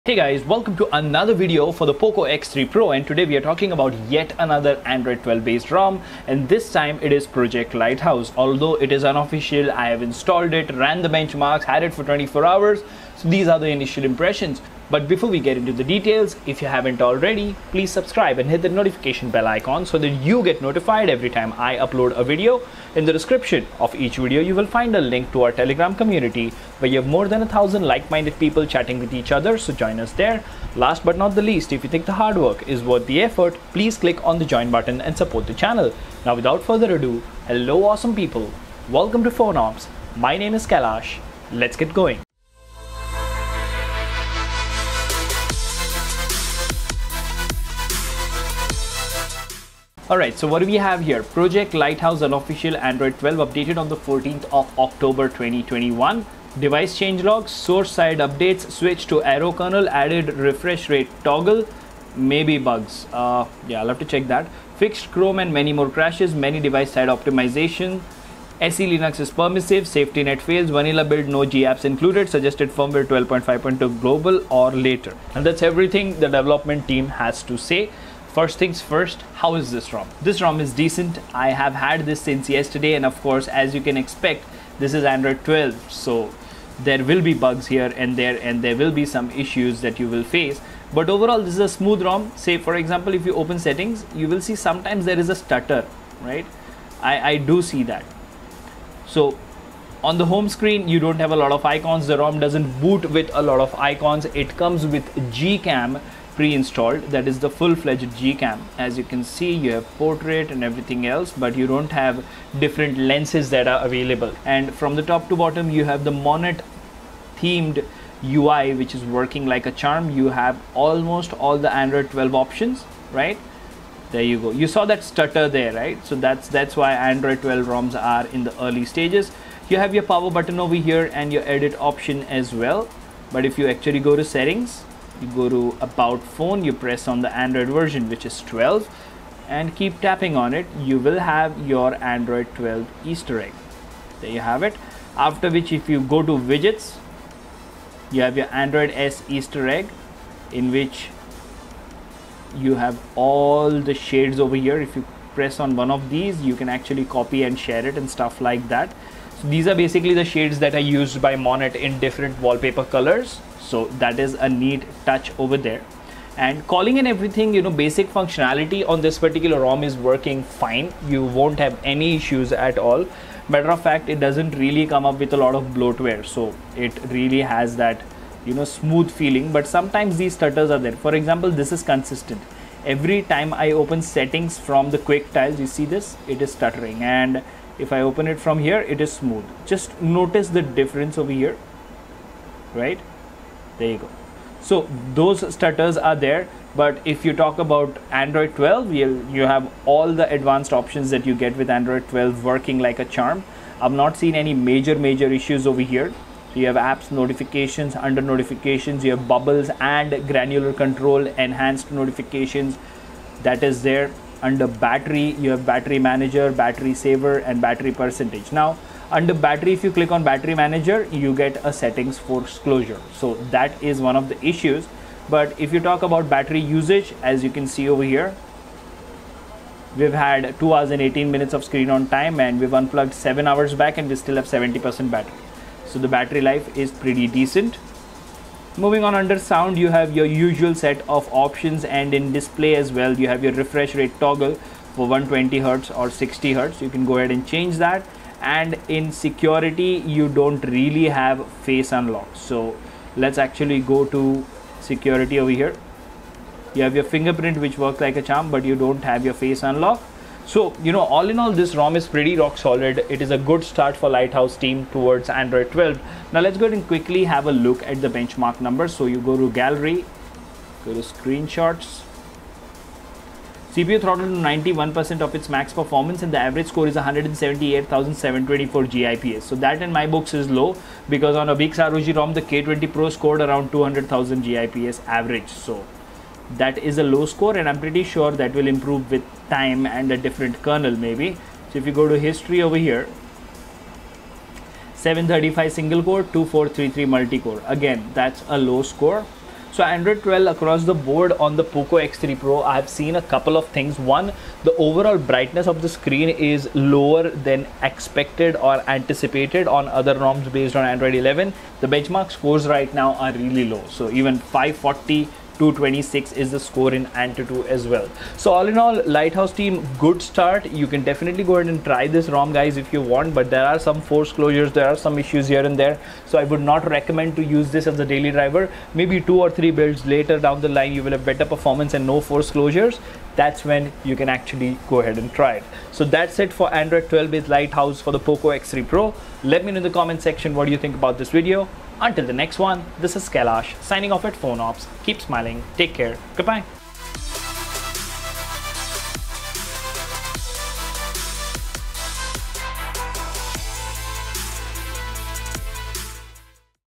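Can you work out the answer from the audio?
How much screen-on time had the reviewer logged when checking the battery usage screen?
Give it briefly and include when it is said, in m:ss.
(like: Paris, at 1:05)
2 hours and 18 minutes, at 3:50.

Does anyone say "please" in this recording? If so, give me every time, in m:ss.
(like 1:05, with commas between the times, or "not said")
0:17, 0:33.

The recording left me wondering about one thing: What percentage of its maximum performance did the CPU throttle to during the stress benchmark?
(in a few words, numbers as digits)
91%.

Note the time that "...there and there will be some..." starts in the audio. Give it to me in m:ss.
1:28.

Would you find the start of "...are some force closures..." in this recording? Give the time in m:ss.
5:23.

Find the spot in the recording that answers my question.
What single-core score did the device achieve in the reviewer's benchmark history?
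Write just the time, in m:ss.
4:54.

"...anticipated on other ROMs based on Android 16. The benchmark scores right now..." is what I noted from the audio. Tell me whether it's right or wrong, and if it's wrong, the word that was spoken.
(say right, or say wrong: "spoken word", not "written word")
wrong: "11", not "16".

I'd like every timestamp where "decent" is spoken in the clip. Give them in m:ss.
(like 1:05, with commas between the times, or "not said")
1:20, 3:57.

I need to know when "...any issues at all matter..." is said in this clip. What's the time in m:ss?
2:51.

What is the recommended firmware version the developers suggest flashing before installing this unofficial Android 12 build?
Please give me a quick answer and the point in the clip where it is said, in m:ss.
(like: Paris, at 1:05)
12.5.2, at 1:13.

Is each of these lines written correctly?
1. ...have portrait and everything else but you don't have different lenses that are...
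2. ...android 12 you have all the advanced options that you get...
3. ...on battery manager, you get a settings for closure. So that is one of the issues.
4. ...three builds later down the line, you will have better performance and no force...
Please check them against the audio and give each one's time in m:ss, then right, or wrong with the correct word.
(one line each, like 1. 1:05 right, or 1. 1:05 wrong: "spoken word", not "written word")
1. 1:49 right
2. 3:18 right
3. 3:40 right
4. 5:29 right.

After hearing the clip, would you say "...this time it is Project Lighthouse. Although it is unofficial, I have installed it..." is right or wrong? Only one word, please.
right.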